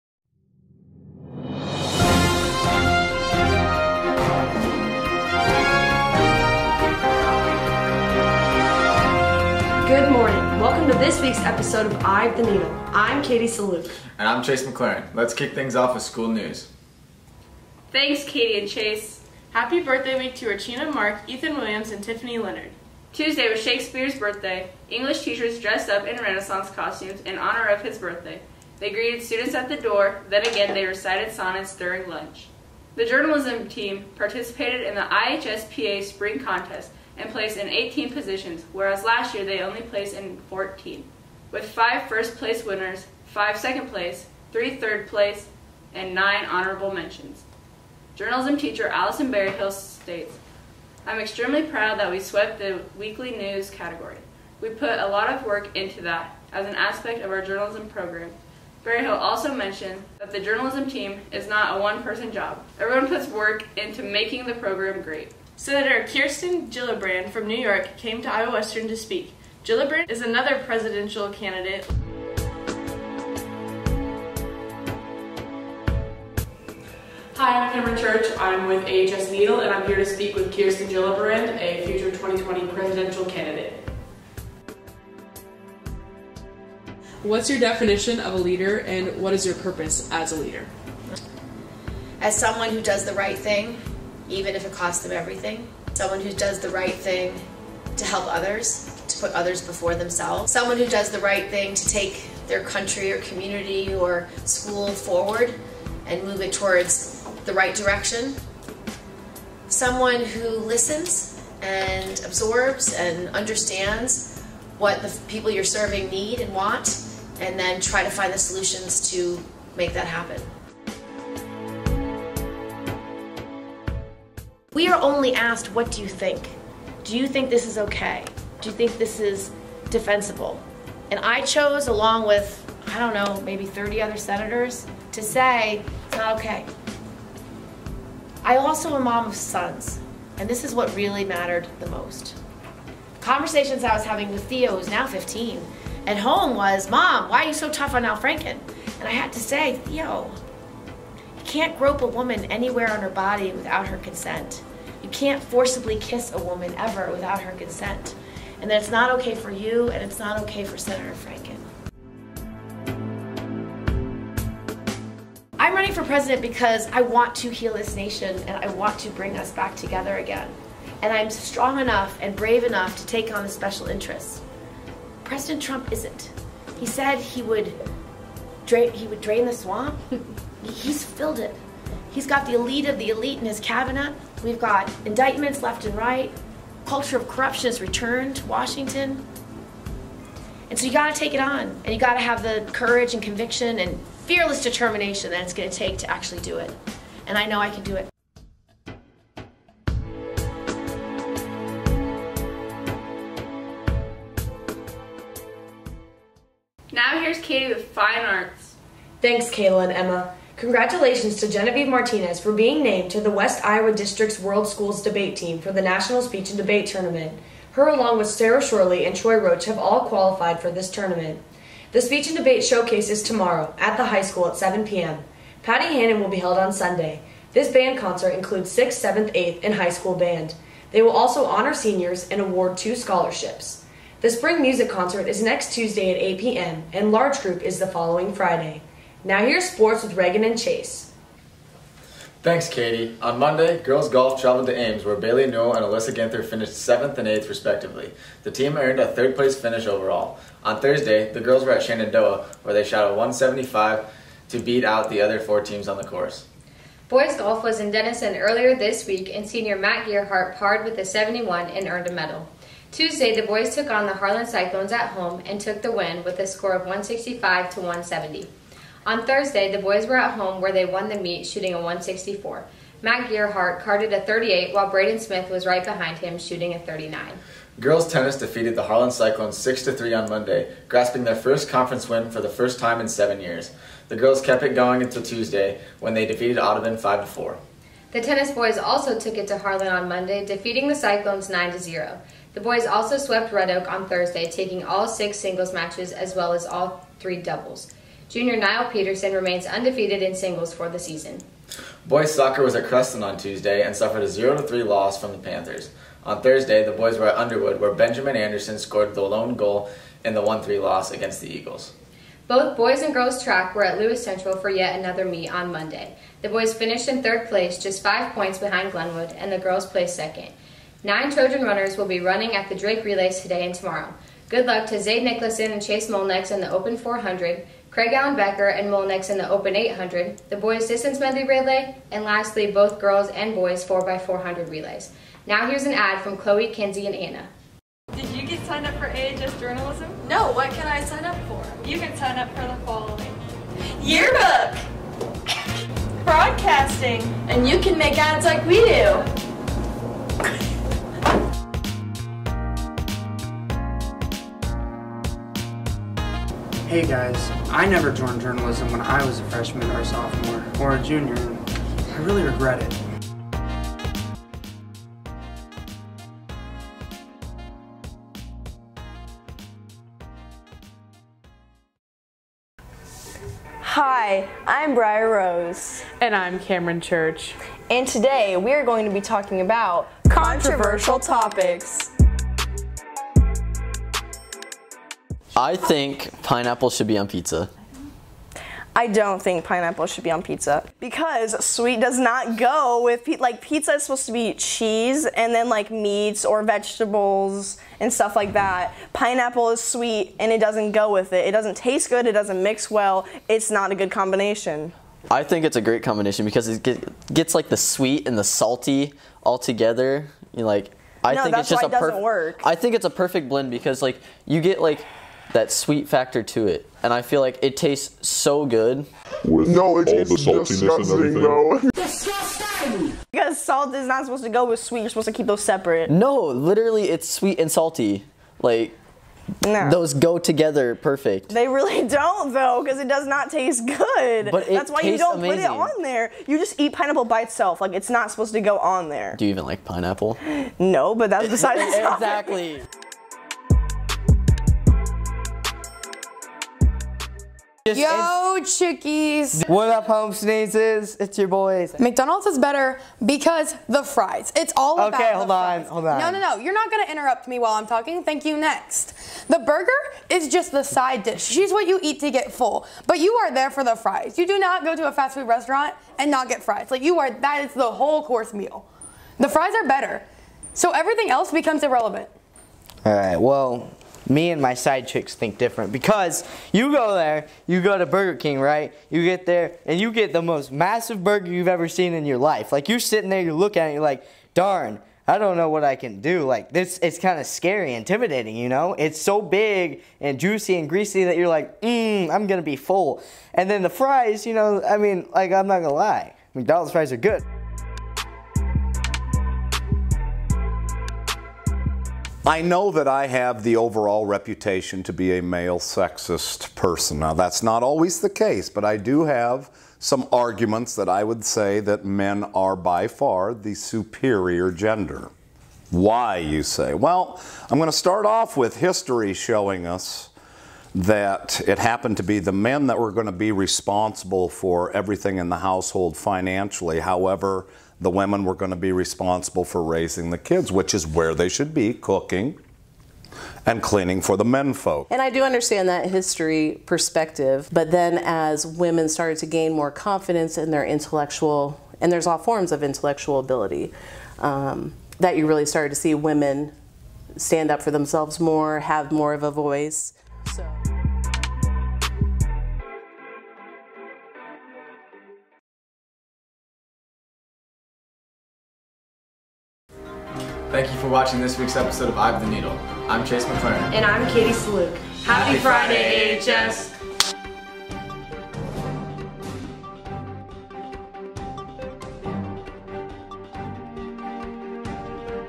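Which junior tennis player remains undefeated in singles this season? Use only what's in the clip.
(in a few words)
Niall Peterson.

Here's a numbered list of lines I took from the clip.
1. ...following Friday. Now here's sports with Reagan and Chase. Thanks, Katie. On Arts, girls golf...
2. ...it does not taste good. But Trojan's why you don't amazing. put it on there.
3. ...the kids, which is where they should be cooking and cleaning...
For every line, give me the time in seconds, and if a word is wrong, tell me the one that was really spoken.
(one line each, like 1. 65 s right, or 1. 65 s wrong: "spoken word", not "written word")
1. 237 s wrong: "Monday", not "Arts"
2. 432 s wrong: "That", not "Trojan"
3. 530 s right.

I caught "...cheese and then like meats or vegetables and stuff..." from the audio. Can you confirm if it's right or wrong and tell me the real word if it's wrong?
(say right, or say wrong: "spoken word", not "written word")
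right.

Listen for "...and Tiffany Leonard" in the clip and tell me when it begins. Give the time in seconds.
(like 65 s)
21 s.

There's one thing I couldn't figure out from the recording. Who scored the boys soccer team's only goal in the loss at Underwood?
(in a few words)
Benjamin Anderson.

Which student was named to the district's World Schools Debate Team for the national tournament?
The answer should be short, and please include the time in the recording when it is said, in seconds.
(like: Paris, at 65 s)
Genevieve Martinez, at 211 s.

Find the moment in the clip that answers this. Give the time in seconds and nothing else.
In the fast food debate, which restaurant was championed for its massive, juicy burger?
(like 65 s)
478 s.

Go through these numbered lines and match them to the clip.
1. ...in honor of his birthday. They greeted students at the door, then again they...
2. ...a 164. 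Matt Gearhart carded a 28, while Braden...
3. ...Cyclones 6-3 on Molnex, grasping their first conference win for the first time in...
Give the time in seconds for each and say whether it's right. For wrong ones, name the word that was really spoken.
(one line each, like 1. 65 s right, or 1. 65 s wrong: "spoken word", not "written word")
1. 27 s right
2. 271 s wrong: "38", not "28"
3. 279 s wrong: "Monday", not "Molnex".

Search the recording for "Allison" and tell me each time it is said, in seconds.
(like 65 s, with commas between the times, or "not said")
48 s.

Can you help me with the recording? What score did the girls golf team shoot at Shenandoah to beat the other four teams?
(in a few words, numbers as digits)
175.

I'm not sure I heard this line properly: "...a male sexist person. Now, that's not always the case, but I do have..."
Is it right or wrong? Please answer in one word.
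right.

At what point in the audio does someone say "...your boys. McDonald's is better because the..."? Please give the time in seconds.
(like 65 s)
451 s.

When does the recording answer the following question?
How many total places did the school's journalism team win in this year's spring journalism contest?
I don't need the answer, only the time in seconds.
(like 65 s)
37 s.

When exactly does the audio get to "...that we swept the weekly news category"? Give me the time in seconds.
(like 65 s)
51 s.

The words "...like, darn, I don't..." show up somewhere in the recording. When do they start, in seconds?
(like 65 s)
484 s.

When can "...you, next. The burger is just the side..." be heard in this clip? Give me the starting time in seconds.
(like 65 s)
458 s.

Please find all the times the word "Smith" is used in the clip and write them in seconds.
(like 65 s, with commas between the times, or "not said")
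275 s.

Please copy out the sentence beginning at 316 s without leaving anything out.
The boys finished in third place, just five points behind Glenwood, and the girls placed second.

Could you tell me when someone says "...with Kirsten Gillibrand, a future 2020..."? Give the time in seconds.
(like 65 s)
80 s.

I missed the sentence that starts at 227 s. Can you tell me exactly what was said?
This band concert includes 6th, 7th, 8th, and high school band.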